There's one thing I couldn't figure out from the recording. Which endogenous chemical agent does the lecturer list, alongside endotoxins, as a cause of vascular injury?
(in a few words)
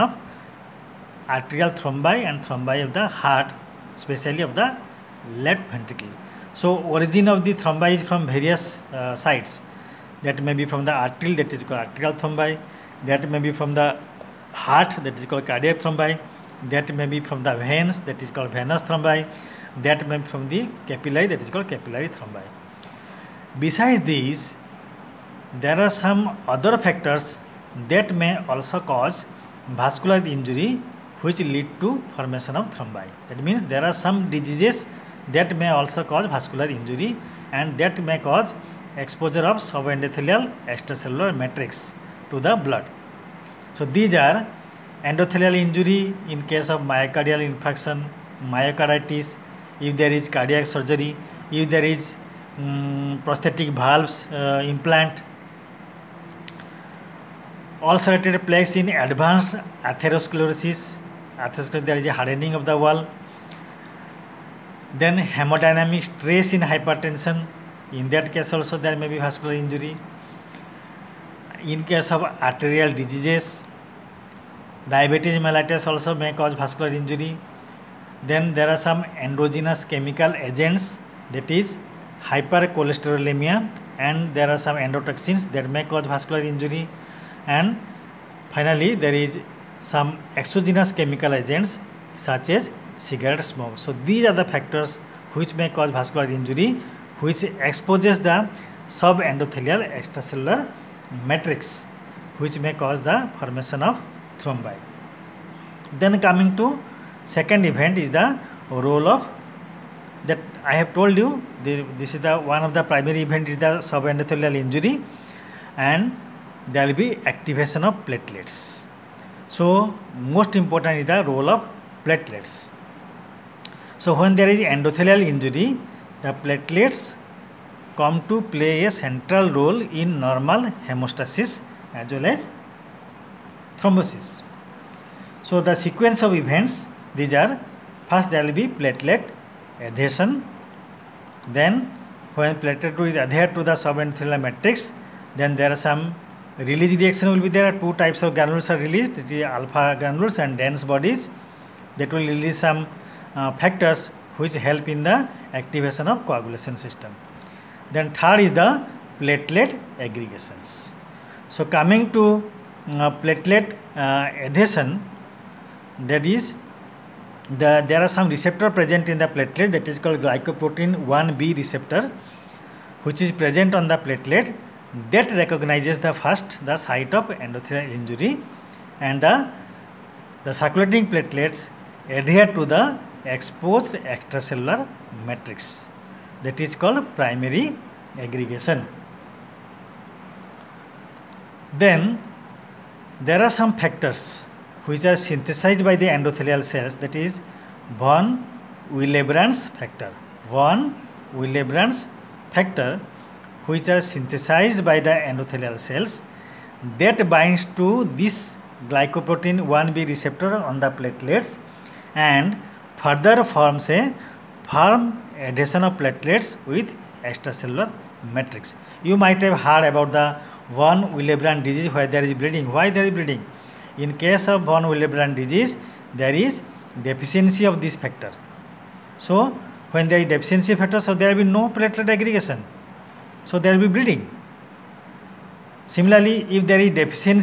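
Hypercholesterolemia.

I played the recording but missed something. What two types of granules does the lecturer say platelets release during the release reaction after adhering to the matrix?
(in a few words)
Alpha granules and dense bodies.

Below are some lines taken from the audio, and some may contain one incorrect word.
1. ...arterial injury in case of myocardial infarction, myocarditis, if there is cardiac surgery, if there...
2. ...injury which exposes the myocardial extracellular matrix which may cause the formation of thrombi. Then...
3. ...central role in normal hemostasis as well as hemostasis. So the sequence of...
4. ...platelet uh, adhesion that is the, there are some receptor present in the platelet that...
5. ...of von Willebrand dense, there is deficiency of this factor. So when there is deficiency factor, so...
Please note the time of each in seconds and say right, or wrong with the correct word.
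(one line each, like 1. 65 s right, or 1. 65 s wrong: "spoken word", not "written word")
1. 45 s wrong: "endothelial", not "arterial"
2. 96 s wrong: "subendothelial", not "myocardial"
3. 128 s wrong: "thrombosis", not "hemostasis"
4. 163 s right
5. 224 s wrong: "disease", not "dense".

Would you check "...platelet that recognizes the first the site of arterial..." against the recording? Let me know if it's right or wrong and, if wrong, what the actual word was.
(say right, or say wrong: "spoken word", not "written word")
wrong: "endothelial", not "arterial".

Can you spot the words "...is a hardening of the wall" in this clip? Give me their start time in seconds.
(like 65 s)
61 s.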